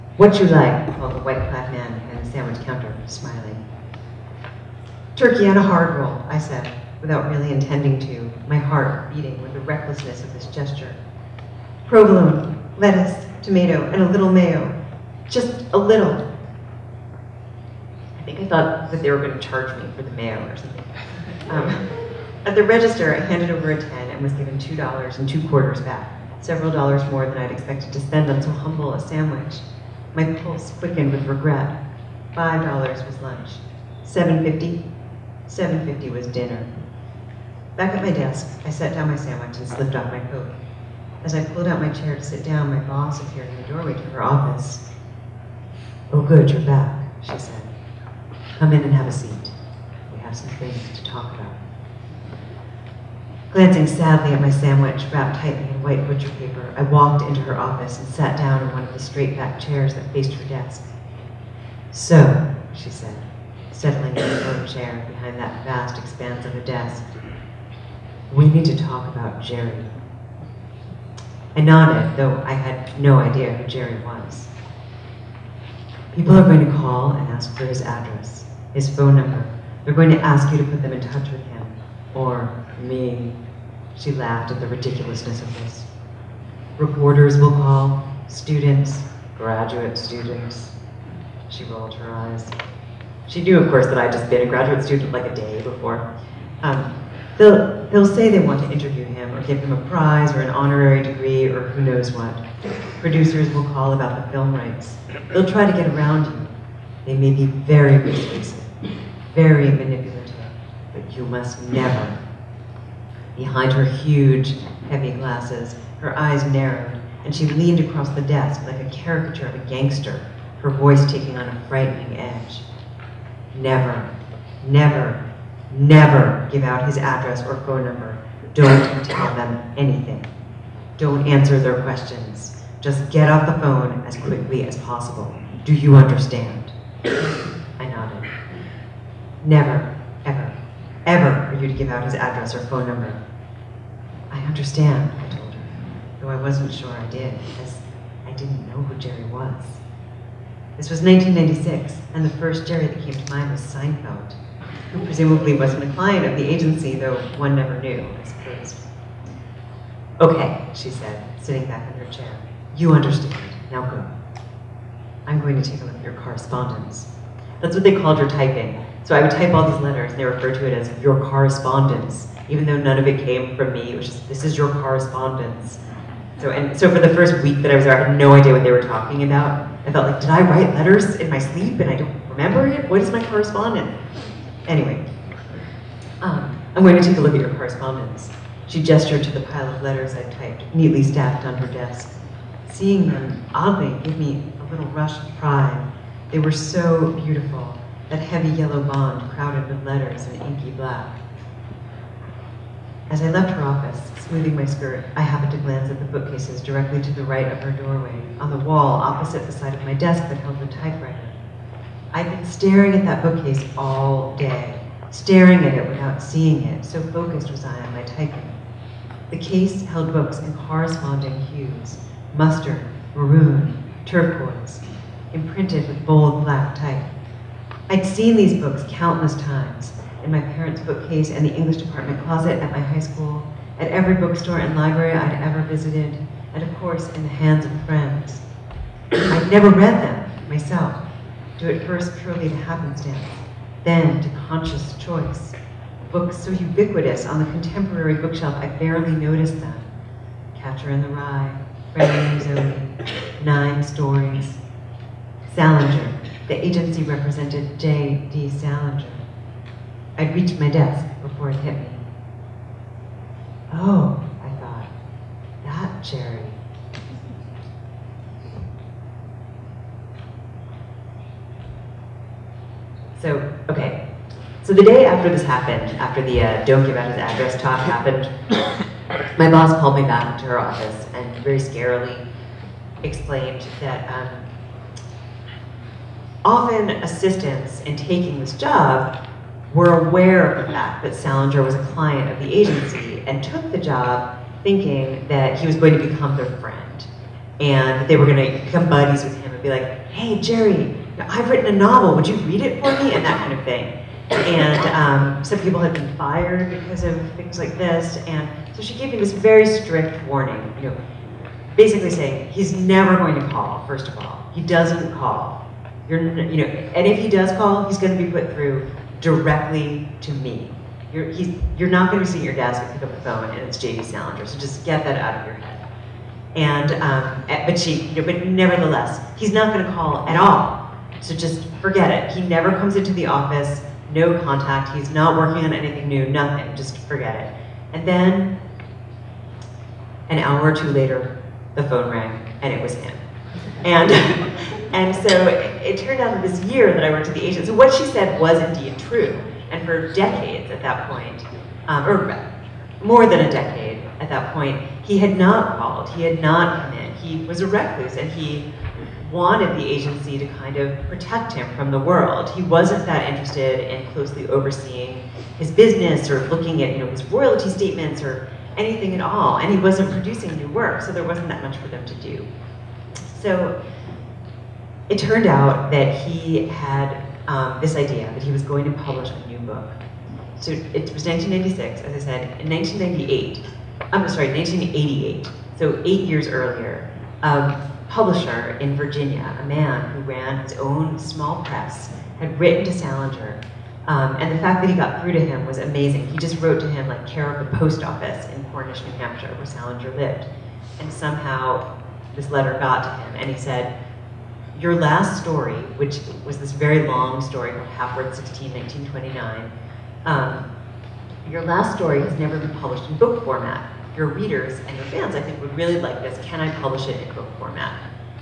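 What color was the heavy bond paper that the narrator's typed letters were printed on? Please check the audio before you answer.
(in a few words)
Yellow.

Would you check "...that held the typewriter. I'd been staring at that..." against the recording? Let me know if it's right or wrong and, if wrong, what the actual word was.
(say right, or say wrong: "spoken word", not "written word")
right.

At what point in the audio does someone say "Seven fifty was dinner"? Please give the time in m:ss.
0:35.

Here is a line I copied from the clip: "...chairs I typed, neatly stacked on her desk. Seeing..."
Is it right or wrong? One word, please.
wrong.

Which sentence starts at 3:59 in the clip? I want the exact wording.
I'd never read them myself, due at first purely to happenstance, then to conscious choice.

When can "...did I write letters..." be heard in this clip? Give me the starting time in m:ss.
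3:00.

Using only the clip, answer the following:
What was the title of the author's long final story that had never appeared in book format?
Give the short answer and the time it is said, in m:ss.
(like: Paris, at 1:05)
Hapworth 16, 1929, at 6:47.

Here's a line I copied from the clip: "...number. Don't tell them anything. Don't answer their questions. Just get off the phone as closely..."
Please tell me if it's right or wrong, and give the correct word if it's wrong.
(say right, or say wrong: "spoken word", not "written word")
wrong: "quickly", not "closely".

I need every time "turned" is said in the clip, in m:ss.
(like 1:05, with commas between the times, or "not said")
5:45, 6:15.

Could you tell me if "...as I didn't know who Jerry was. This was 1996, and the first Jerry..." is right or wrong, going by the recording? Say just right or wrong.
right.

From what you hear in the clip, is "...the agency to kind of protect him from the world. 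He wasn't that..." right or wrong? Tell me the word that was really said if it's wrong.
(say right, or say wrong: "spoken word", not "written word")
right.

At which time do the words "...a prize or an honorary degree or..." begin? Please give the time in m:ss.
1:39.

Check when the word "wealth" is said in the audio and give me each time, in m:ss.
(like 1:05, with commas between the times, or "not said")
not said.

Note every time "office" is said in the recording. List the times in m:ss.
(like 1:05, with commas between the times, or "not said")
0:44, 0:57, 3:23, 4:40, 5:33, 6:38.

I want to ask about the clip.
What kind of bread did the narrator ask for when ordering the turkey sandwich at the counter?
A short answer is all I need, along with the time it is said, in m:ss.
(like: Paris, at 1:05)
Hard roll, at 0:05.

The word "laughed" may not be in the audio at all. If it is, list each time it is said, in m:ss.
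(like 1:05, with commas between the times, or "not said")
1:24.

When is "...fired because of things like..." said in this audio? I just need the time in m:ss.
5:06.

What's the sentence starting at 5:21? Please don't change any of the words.
You're, he's, you're not going to see your desk and pick up the phone and it's J.D.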